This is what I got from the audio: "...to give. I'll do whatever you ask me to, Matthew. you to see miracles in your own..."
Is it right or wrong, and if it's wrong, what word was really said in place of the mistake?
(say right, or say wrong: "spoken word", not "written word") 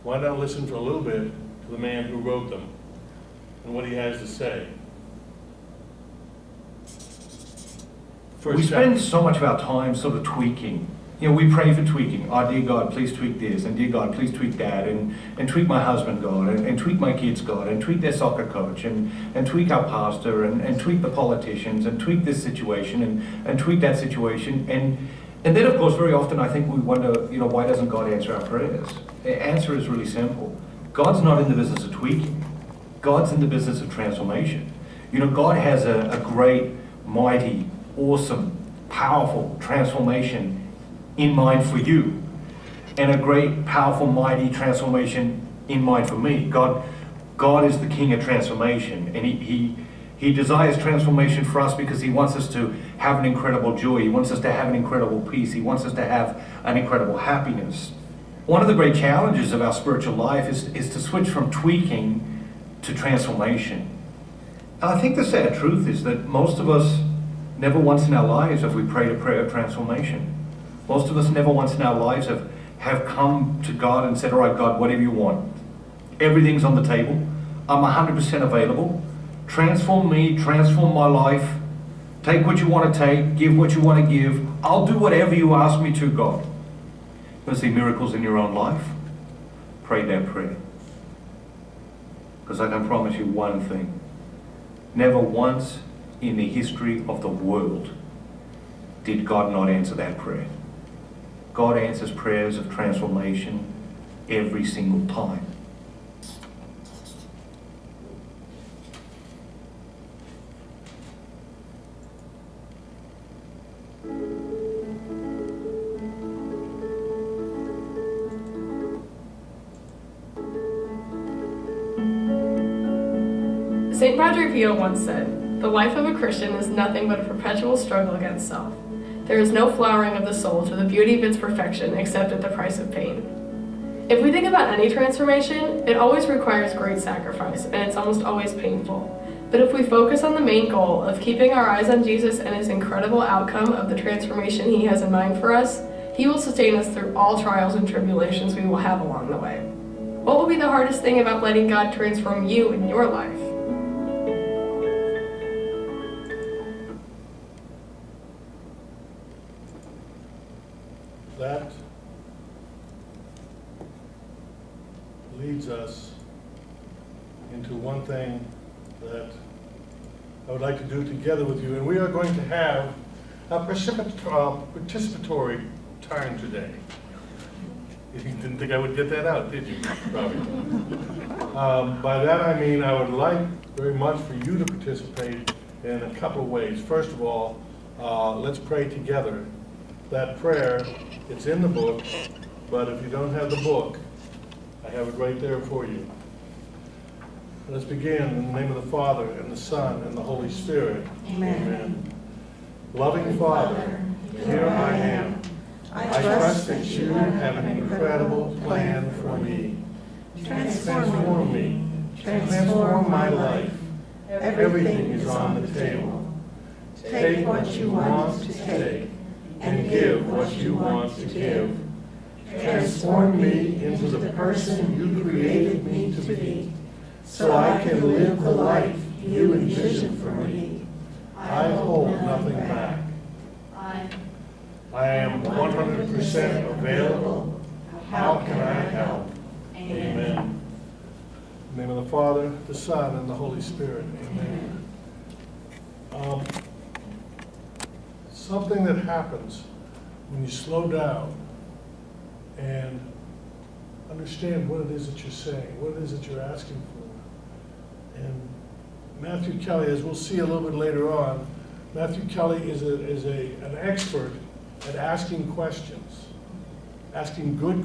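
wrong: "God", not "Matthew".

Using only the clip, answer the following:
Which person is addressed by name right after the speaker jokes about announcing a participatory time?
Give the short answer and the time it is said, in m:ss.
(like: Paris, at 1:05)
Robbie, at 3:00.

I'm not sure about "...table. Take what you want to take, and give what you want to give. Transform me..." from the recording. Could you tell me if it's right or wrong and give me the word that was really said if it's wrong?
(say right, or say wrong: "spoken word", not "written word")
right.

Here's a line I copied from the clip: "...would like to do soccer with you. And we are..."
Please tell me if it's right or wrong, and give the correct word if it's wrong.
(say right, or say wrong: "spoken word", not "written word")
wrong: "together", not "soccer".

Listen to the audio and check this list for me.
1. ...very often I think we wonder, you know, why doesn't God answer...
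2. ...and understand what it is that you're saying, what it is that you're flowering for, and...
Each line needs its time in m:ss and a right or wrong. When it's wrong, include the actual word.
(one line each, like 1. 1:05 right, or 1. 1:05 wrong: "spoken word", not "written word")
1. 0:25 right
2. 4:12 wrong: "asking", not "flowering".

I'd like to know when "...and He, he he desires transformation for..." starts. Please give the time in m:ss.
0:49.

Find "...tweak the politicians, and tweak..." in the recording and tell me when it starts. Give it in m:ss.
0:20.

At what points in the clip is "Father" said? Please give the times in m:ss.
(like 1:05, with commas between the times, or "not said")
3:18, 3:23, 4:02.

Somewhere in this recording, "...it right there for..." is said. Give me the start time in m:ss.
3:15.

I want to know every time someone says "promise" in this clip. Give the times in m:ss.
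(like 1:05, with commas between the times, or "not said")
1:32.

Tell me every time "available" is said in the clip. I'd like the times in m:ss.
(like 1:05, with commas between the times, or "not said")
1:18, 3:56.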